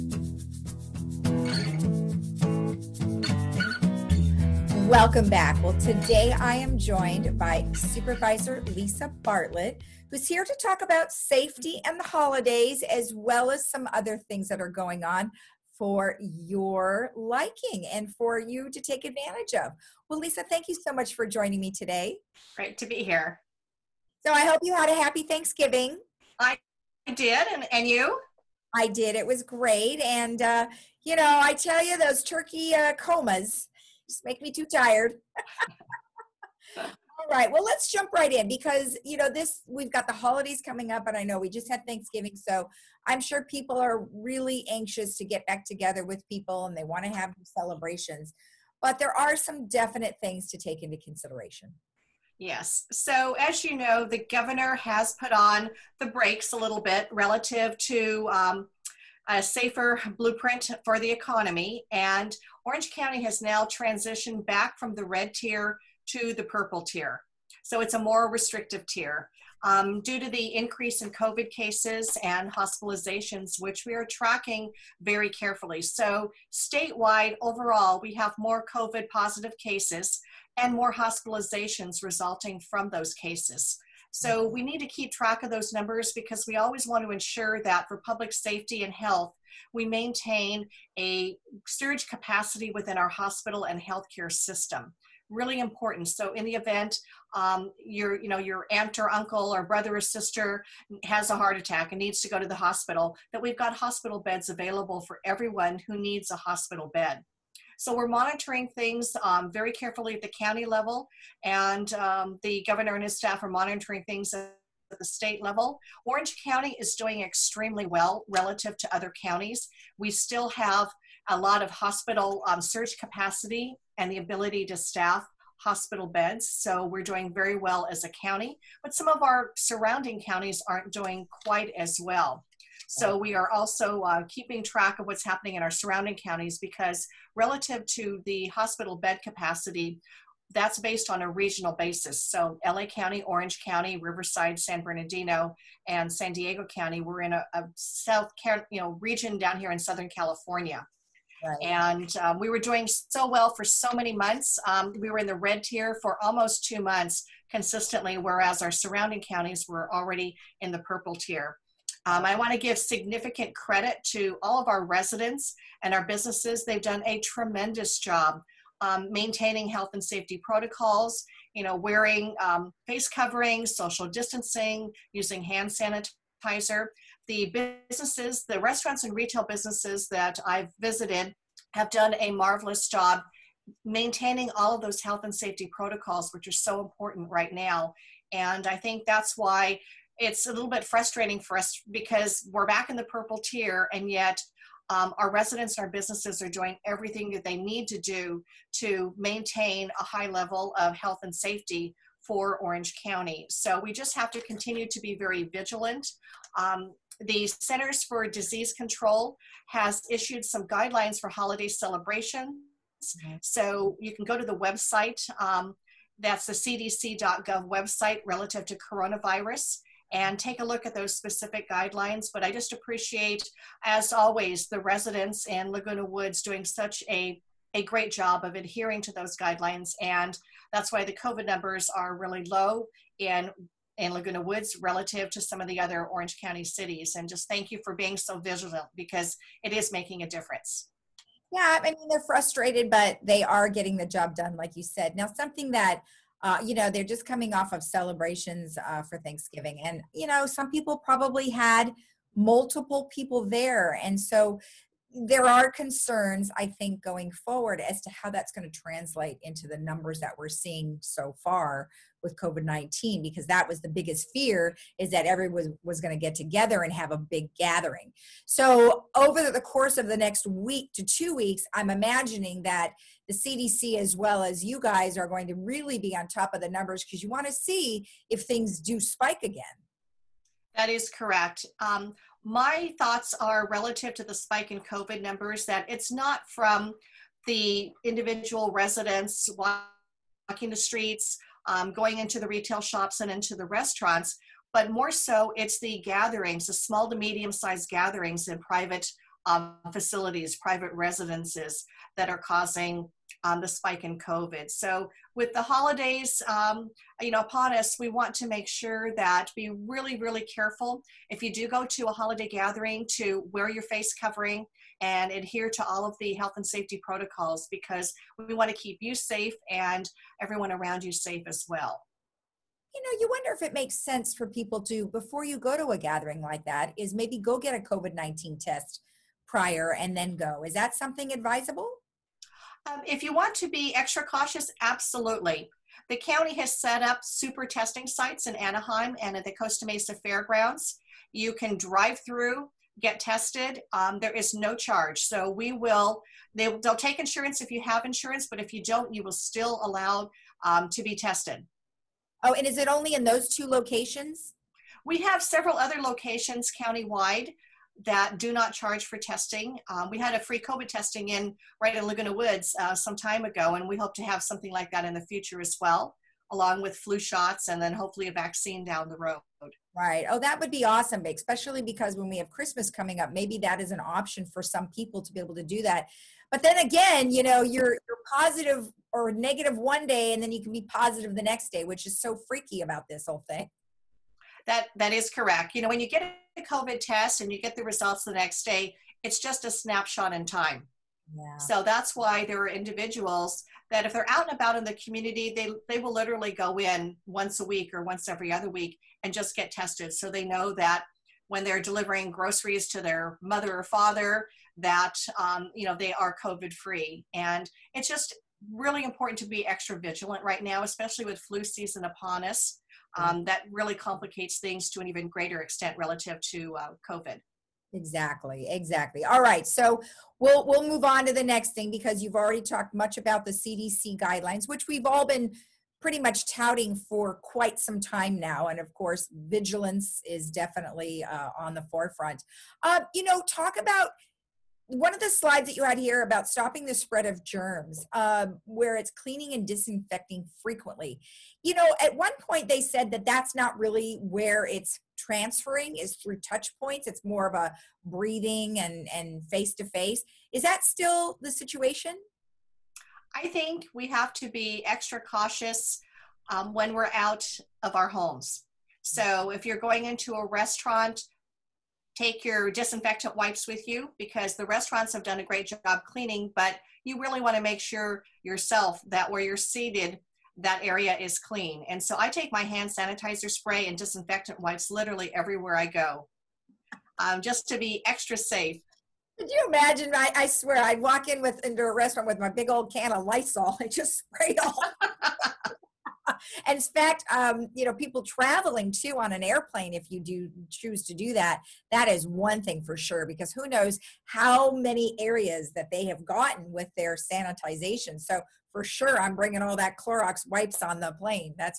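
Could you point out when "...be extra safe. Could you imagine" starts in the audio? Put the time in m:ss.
7:57.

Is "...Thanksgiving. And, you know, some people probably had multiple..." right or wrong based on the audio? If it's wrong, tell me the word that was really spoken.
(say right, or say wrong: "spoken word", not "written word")
right.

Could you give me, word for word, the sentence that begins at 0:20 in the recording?
Well, Lisa, thank you so much for joining me today.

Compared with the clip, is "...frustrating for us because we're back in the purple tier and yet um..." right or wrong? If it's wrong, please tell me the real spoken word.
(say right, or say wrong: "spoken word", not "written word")
right.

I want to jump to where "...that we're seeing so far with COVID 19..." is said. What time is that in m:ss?
4:20.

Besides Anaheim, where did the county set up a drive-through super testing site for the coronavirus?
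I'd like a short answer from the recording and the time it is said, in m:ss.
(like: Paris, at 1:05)
Costa Mesa Fairgrounds, at 5:39.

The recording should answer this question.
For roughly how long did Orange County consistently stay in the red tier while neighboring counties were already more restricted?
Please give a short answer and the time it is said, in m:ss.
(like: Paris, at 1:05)
almost two months, at 2:36.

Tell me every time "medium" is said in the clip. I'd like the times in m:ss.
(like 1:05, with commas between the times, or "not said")
4:57.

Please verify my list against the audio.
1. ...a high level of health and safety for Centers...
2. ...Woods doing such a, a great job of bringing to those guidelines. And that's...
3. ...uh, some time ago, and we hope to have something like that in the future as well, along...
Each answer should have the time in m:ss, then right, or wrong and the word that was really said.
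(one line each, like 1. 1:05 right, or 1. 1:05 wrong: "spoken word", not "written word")
1. 3:19 wrong: "Orange", not "Centers"
2. 3:46 wrong: "adhering", not "bringing"
3. 6:02 right.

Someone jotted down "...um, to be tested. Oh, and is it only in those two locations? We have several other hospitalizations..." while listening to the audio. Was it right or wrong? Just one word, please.
wrong.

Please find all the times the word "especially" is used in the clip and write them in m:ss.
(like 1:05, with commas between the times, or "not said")
6:11, 6:50.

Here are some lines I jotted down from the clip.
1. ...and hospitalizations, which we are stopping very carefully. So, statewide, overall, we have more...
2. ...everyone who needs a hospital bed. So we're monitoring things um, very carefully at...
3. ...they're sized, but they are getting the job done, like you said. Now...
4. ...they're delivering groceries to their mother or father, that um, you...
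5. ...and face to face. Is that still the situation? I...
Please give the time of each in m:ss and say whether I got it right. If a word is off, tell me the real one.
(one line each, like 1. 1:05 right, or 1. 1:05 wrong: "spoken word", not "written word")
1. 1:12 wrong: "tracking", not "stopping"
2. 1:45 right
3. 4:02 wrong: "frustrated", not "sized"
4. 6:41 right
5. 7:29 right.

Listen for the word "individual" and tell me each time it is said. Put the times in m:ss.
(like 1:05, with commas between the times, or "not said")
4:48, 6:32.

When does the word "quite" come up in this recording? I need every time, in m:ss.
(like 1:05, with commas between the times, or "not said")
2:11, 7:07.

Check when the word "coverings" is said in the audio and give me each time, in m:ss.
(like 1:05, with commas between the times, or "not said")
2:53, 5:14.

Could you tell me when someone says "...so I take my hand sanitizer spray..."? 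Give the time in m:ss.
7:52.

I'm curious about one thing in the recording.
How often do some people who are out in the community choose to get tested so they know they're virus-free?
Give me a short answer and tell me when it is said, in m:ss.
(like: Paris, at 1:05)
once a week, at 6:37.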